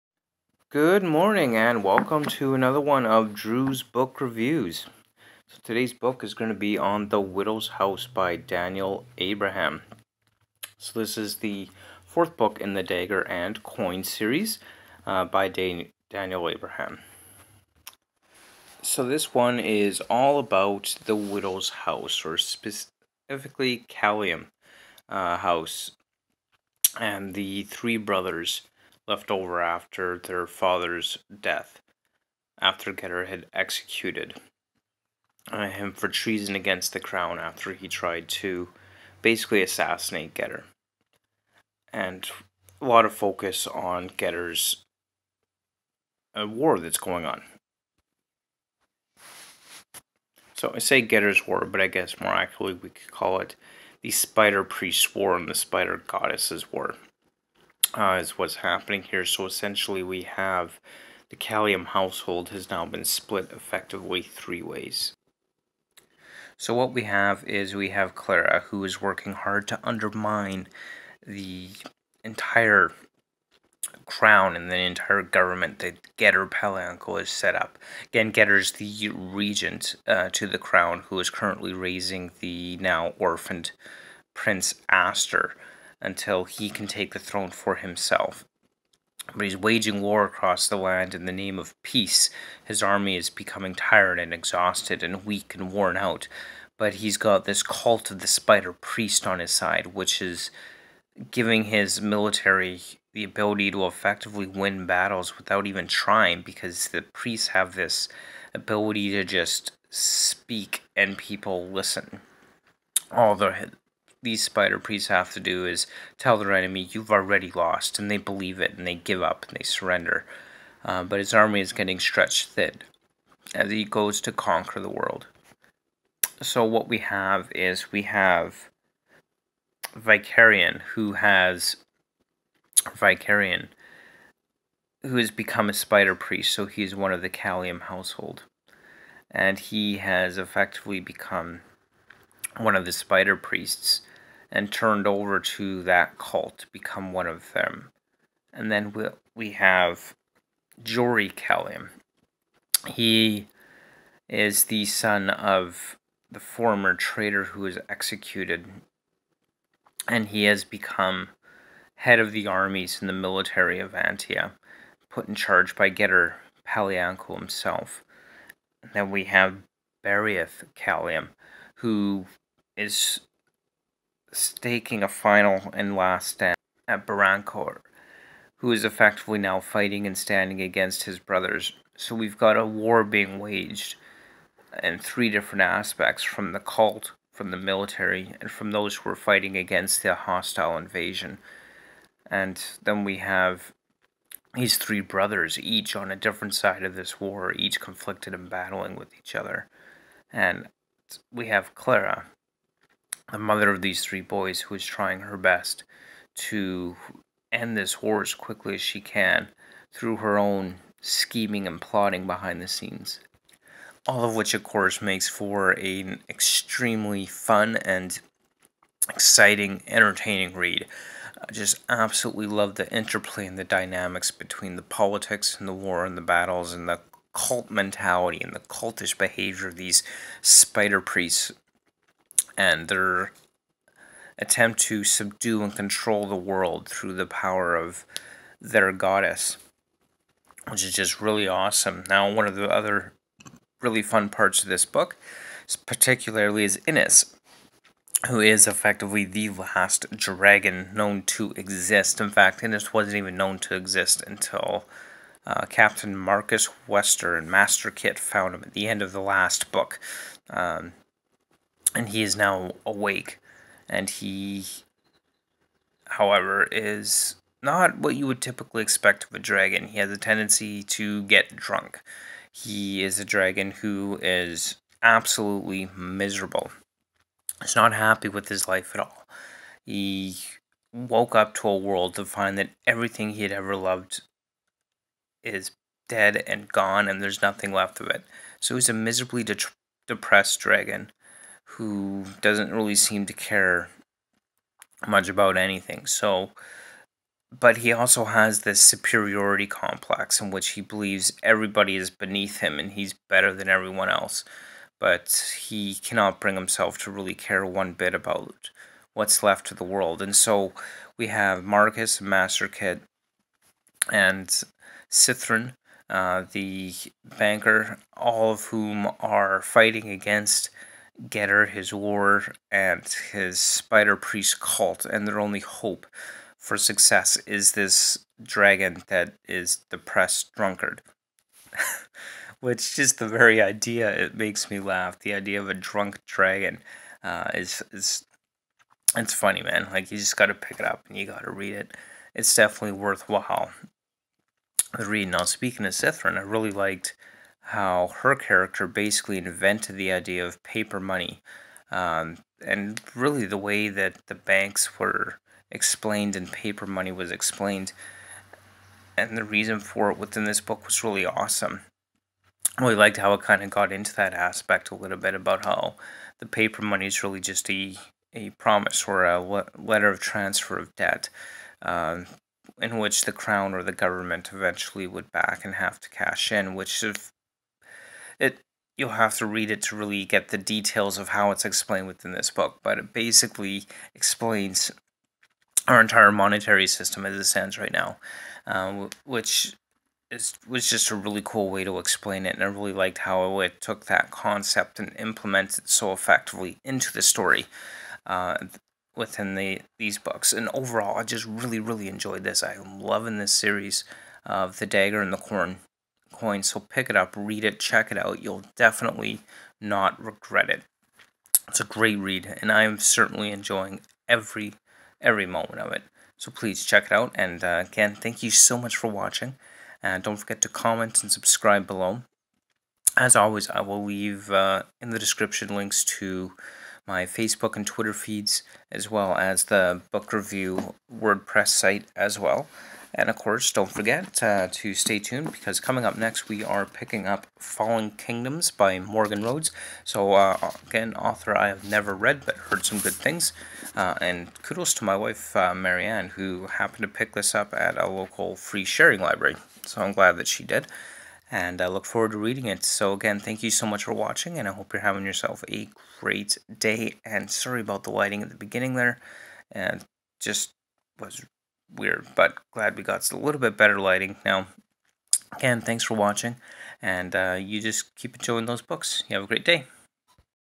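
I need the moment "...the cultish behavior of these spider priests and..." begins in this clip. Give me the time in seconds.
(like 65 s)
228 s.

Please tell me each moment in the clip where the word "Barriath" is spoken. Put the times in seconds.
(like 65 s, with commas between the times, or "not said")
170 s.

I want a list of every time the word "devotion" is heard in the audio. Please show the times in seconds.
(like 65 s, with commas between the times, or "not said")
not said.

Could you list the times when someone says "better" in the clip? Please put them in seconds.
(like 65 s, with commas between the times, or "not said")
303 s, 463 s.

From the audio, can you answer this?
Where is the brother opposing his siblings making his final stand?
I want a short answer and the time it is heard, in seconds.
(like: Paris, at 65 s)
Barancourt, at 177 s.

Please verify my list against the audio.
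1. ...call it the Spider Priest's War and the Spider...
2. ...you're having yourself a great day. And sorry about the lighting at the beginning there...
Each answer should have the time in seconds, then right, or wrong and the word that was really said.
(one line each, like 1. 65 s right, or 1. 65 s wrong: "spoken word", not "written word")
1. 53 s right
2. 454 s right.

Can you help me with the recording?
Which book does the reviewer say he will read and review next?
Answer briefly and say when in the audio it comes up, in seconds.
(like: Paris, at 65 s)
Fallen Kingdoms, at 437 s.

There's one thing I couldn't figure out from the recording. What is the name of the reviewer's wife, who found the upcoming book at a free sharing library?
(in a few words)
Marianne.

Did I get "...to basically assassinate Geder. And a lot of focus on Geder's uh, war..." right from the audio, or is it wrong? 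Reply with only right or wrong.
right.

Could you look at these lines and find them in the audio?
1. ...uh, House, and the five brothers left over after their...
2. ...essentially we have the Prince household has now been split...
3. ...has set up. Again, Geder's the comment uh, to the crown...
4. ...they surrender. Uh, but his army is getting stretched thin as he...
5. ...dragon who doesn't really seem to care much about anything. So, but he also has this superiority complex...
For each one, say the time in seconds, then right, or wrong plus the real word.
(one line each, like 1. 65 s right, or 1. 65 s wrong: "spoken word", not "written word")
1. 25 s wrong: "three", not "five"
2. 59 s wrong: "Kalliam", not "Prince"
3. 77 s wrong: "regent", not "comment"
4. 119 s right
5. 290 s right.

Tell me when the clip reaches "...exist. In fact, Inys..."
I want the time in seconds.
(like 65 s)
251 s.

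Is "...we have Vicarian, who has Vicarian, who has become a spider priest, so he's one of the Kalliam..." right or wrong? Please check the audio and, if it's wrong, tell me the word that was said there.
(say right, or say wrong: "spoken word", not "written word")
right.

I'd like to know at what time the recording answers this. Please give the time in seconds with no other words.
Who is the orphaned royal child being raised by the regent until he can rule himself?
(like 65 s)
84 s.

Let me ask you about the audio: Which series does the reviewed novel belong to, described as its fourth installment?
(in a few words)
Dagger and Coin.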